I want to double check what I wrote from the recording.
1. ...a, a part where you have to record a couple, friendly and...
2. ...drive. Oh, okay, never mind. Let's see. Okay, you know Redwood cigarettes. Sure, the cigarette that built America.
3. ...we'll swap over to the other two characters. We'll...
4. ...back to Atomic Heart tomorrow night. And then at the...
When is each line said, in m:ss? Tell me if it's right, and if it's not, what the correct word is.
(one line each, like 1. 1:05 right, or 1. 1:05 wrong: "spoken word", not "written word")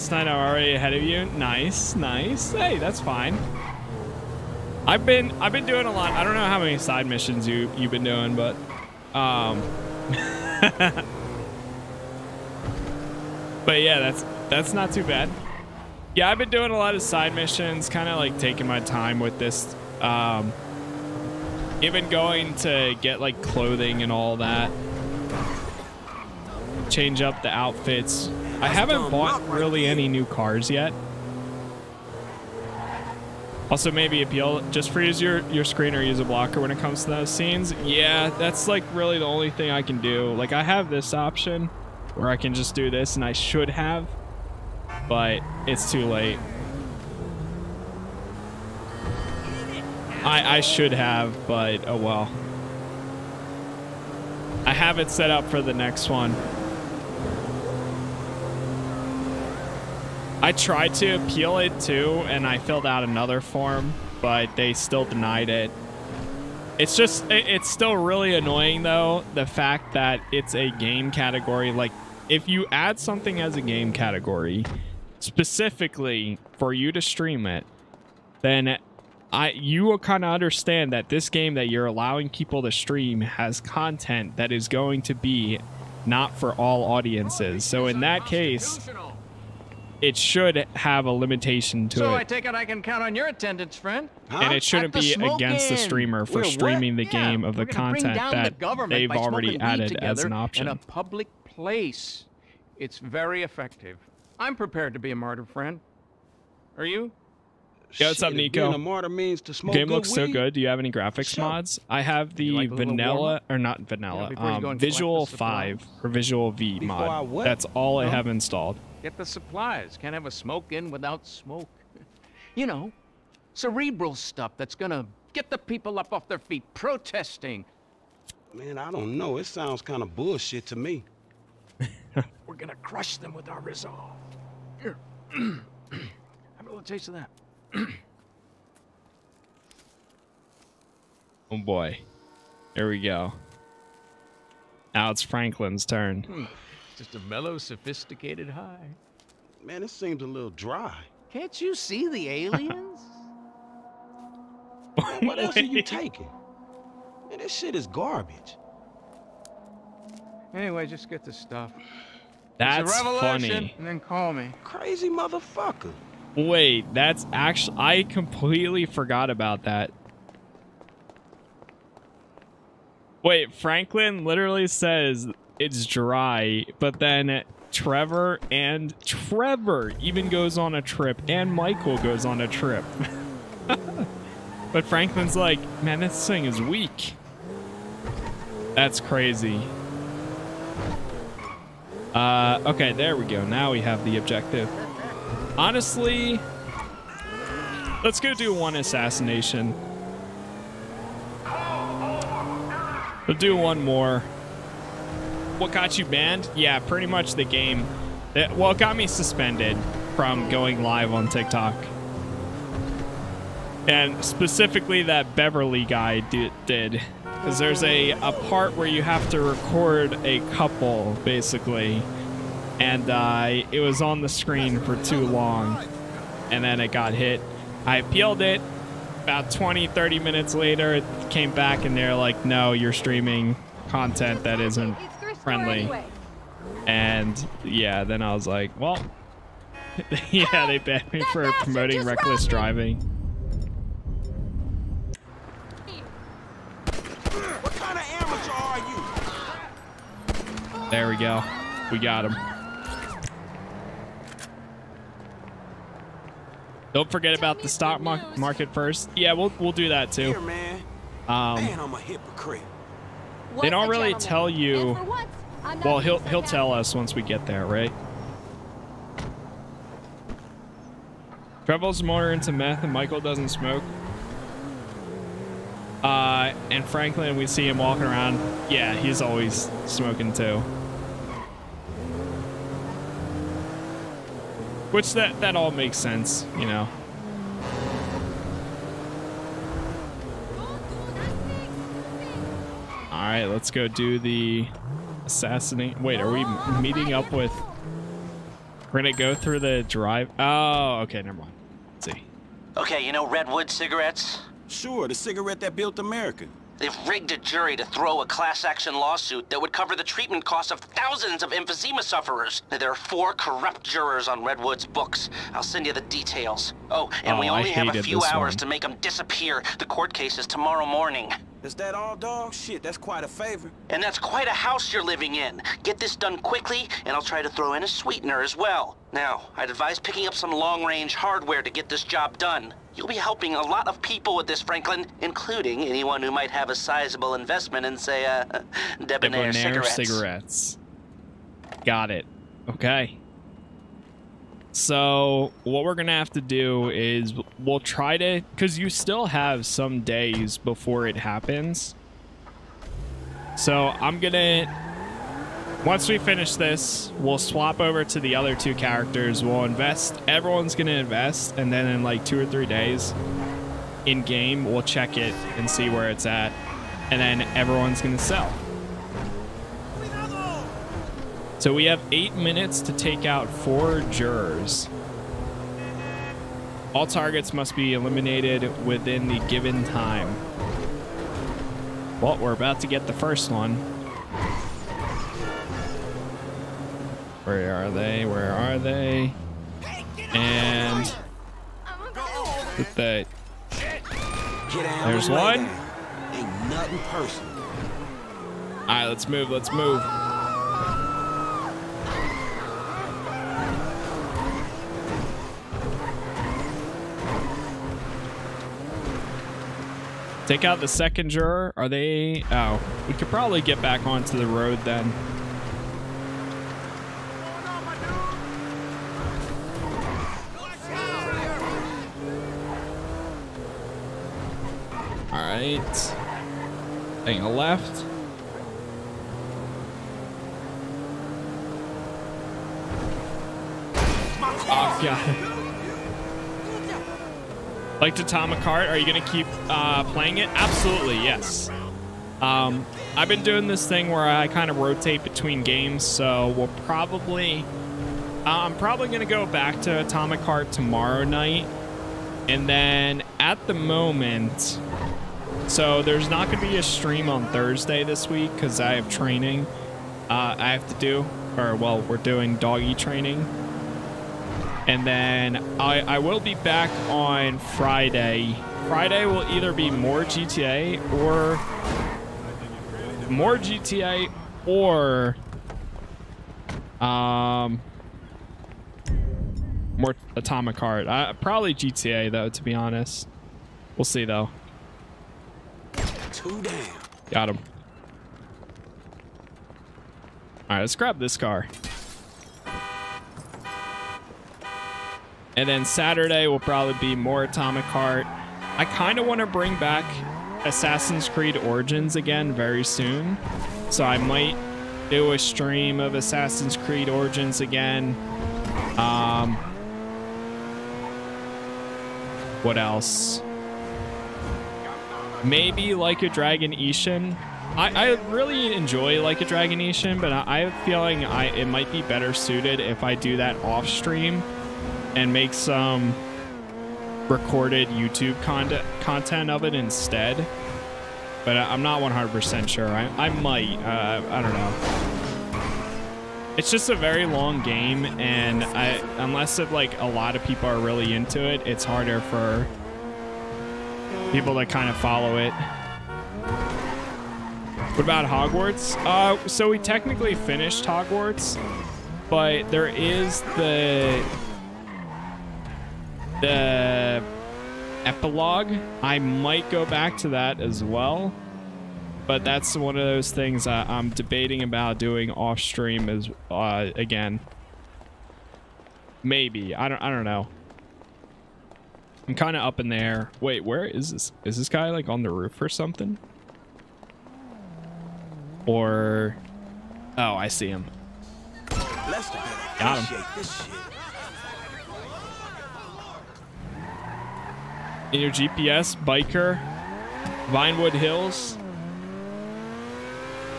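1. 3:37 wrong: "basically", not "friendly"
2. 4:59 right
3. 5:57 right
4. 7:29 right.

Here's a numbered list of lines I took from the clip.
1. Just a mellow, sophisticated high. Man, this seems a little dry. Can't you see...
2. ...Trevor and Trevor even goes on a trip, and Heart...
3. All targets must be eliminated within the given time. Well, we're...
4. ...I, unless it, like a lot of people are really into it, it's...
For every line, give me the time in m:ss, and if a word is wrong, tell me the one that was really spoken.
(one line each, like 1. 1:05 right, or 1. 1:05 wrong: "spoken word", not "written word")
1. 2:26 right
2. 2:57 wrong: "Michael", not "Heart"
3. 6:16 right
4. 8:58 right.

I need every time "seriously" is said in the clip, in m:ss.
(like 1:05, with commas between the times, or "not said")
not said.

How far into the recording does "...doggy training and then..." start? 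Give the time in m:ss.
7:42.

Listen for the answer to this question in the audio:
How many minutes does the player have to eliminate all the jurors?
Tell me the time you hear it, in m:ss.
6:12.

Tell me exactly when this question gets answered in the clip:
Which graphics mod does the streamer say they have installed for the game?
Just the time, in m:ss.
1:54.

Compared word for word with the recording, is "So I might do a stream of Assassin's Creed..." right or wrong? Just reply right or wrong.
right.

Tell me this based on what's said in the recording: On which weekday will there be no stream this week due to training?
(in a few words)
Thursday.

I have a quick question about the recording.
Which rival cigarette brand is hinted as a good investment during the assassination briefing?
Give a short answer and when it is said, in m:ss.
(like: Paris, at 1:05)
Debonair, at 5:39.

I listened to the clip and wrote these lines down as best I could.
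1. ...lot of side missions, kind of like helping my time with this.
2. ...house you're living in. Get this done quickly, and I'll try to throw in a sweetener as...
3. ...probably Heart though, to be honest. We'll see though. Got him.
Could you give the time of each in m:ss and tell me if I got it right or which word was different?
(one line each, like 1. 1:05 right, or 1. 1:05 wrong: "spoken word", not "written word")
1. 0:16 wrong: "taking", not "helping"
2. 5:24 right
3. 8:01 wrong: "GTA", not "Heart".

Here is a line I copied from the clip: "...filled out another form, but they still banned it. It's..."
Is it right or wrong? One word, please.
wrong.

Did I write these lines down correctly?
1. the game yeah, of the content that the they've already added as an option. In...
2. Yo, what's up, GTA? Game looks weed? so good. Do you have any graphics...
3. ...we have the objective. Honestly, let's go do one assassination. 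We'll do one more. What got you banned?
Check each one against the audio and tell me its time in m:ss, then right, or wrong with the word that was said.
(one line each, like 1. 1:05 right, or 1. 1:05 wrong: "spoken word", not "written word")
1. 1:37 right
2. 1:47 wrong: "Nico", not "GTA"
3. 3:13 right.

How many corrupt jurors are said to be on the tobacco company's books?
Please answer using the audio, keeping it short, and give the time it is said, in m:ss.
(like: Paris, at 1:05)
4, at 5:12.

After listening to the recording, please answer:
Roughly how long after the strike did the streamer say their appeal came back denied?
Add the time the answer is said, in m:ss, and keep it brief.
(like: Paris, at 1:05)
20-30 minutes, at 3:49.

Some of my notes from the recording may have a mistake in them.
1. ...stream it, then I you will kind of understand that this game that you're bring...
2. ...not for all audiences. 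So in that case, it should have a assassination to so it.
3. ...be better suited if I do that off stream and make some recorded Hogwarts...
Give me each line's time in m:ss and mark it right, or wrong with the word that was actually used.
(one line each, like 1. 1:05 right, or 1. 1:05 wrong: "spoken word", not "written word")
1. 1:17 wrong: "allowing", not "bring"
2. 1:26 wrong: "limitation", not "assassination"
3. 8:41 wrong: "YouTube", not "Hogwarts".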